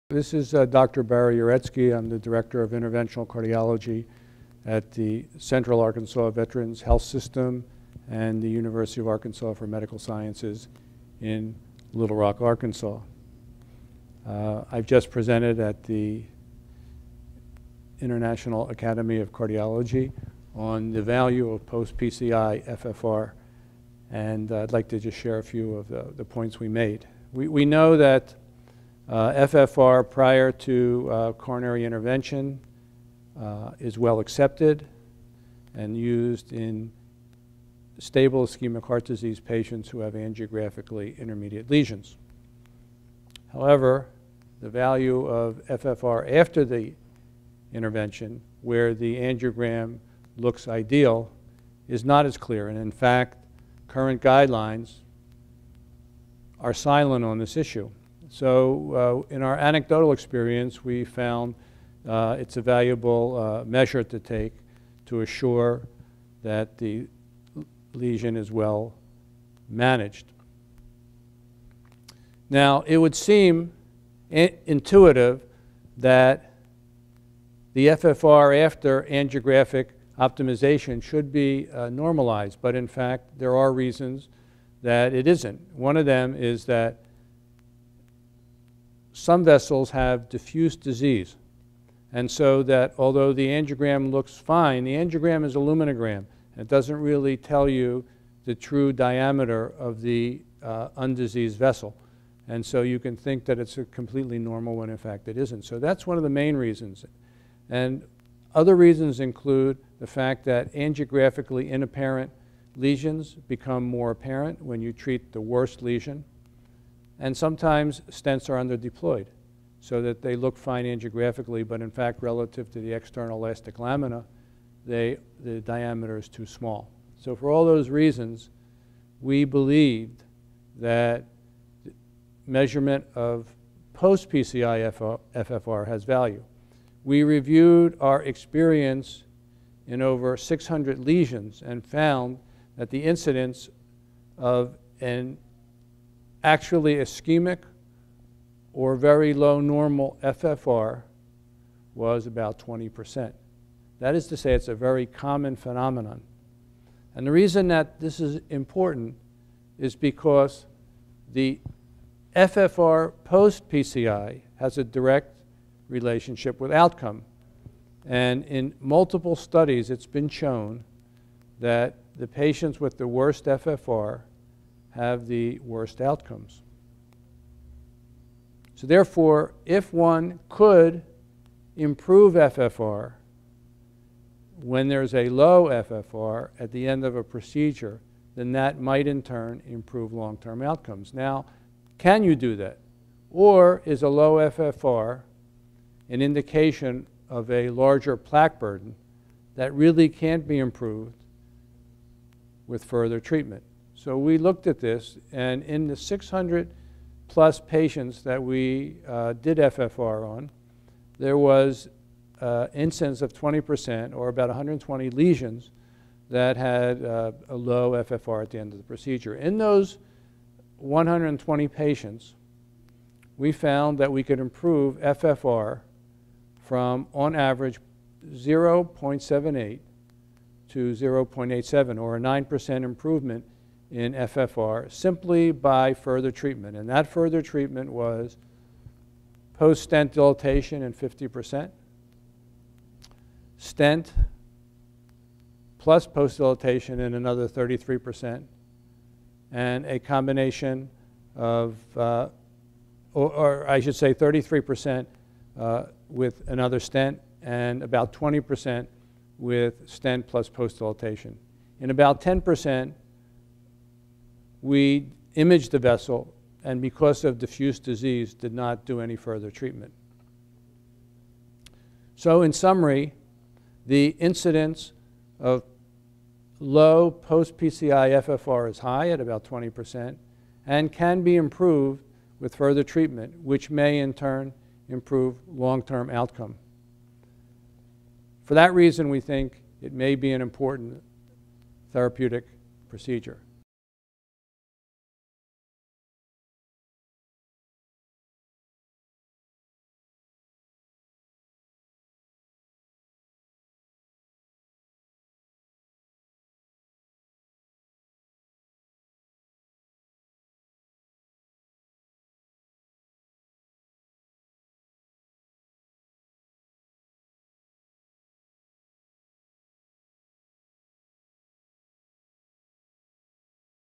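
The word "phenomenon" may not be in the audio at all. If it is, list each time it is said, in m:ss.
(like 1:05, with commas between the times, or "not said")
2:35.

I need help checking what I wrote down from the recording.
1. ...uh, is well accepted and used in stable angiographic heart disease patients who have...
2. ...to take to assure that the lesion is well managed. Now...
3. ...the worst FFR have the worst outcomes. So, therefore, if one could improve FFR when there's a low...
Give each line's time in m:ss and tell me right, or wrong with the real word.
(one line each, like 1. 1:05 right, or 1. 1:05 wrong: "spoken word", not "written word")
1. 0:33 wrong: "ischemic", not "angiographic"
2. 1:04 right
3. 2:52 right.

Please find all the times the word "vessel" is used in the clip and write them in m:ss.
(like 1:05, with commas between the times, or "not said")
1:29, 1:41, 4:25.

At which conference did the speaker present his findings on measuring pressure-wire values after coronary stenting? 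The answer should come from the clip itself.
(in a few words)
International Academy of Cardiology.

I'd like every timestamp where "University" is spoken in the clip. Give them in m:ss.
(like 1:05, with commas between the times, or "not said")
0:08.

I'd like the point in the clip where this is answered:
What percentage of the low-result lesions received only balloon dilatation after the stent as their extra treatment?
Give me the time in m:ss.
4:00.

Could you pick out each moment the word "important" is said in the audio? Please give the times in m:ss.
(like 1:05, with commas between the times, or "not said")
2:38, 4:50.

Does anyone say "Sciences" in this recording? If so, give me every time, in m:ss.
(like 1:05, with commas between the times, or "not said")
0:09.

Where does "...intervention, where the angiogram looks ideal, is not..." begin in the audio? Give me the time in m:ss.
0:47.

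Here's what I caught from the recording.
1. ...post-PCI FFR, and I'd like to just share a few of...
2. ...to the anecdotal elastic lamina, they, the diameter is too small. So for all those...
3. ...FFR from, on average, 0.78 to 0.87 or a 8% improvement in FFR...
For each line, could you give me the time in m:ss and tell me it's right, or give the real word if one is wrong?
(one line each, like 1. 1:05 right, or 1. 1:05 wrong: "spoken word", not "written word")
1. 0:21 right
2. 2:02 wrong: "external", not "anecdotal"
3. 3:44 wrong: "9", not "8".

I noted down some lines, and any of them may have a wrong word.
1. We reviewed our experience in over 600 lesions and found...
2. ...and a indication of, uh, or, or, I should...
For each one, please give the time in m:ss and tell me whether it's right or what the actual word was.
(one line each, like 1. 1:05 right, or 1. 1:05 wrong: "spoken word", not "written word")
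1. 2:17 right
2. 4:09 wrong: "combination", not "indication".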